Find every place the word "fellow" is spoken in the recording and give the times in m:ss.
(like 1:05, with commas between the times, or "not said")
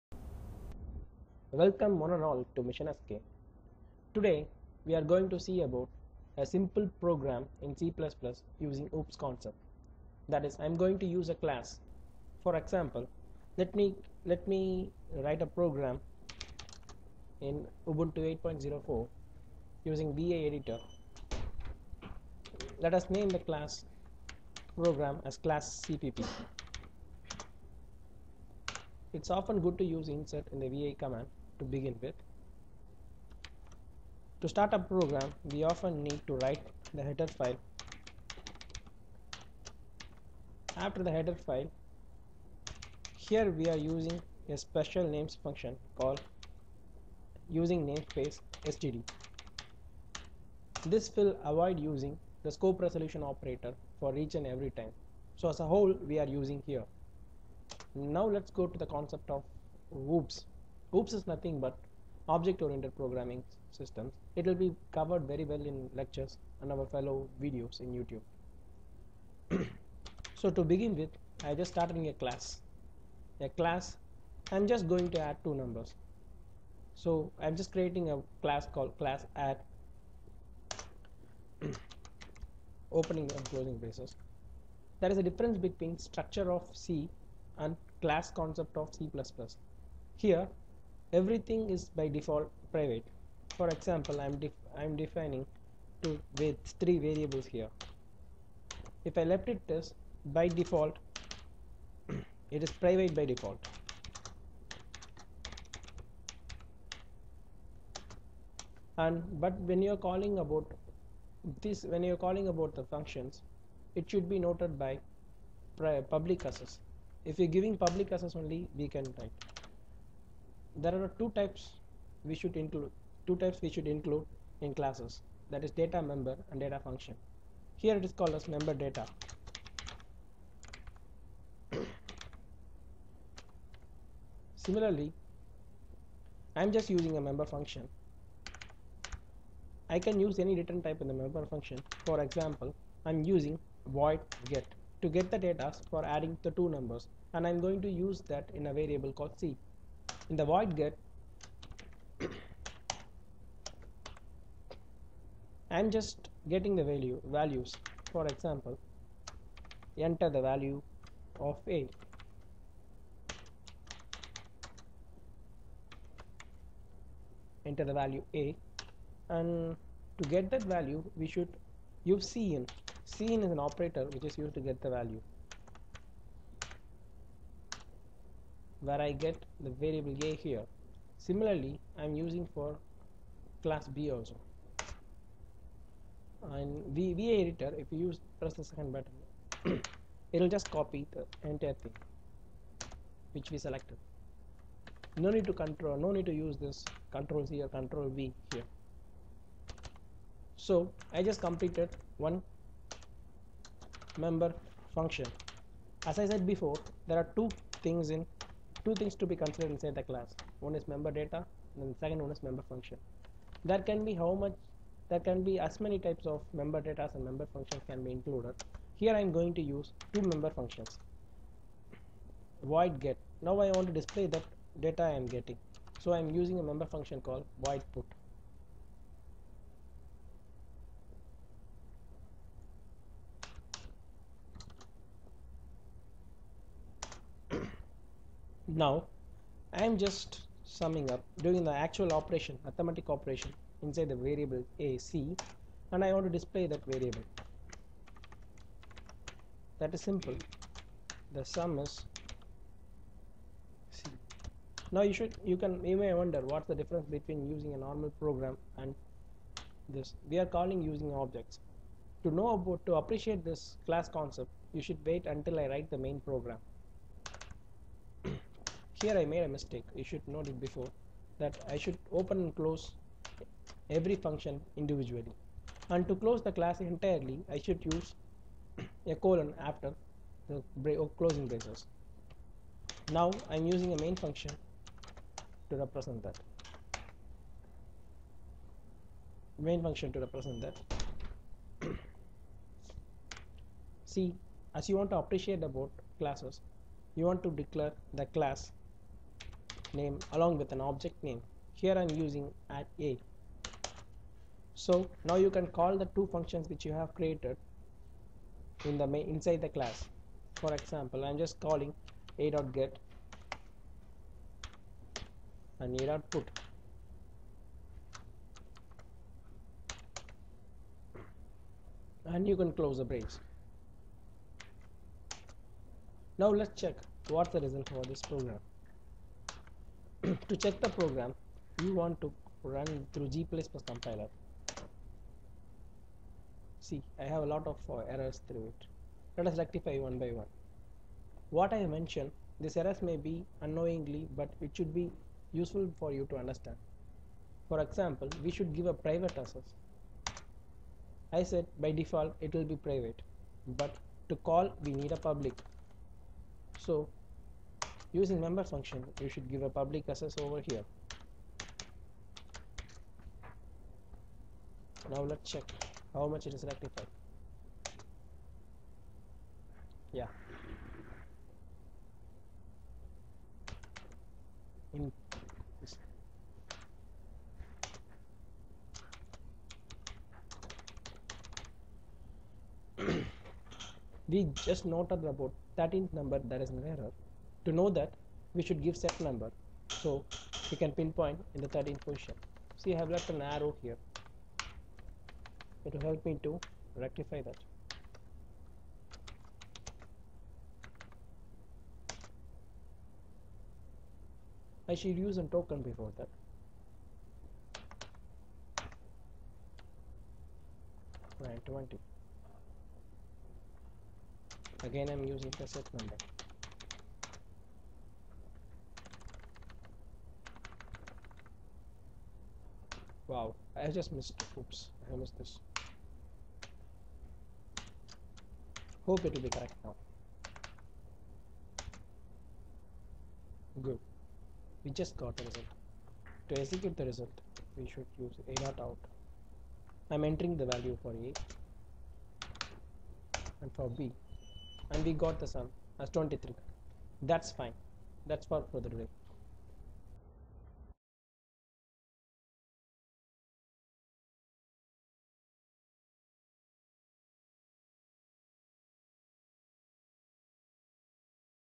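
1:06.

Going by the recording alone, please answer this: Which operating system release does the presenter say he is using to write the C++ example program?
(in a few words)
Ubuntu 8.04.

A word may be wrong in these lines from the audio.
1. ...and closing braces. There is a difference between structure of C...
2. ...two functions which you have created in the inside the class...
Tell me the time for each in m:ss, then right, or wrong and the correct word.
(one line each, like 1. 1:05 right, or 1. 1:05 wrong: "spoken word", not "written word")
1. 1:23 right
2. 5:06 right.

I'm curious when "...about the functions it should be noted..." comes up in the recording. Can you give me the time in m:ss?
1:52.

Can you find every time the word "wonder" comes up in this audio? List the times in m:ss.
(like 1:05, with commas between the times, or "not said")
4:16.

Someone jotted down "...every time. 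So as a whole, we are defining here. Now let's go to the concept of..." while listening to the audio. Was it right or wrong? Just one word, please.
wrong.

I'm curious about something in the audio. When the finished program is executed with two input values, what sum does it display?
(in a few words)
23.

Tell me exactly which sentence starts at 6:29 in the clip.
So we can pinpoint in the 13th position.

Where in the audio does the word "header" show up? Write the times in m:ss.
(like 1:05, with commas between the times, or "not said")
0:37, 0:41.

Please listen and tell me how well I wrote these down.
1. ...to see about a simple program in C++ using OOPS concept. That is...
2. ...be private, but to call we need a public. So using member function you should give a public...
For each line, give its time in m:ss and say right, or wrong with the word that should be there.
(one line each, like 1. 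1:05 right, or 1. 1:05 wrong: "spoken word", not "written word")
1. 0:05 right
2. 5:52 right.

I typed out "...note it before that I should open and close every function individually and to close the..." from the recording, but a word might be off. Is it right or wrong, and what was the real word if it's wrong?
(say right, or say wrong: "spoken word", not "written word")
right.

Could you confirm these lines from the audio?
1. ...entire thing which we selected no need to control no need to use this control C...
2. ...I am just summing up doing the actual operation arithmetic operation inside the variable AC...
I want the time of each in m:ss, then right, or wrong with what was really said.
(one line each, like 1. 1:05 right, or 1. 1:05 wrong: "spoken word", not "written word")
1. 3:11 right
2. 3:59 right.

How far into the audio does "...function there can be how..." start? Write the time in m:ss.
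3:32.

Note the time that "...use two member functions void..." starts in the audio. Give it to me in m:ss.
3:39.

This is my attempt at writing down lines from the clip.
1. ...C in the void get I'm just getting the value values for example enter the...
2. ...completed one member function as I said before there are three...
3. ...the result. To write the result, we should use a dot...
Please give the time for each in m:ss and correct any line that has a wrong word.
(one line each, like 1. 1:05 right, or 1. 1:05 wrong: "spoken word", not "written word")
1. 2:29 right
2. 3:21 wrong: "two", not "three"
3. 7:15 wrong: "execute", not "write".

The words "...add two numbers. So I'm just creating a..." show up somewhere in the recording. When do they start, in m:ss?
1:15.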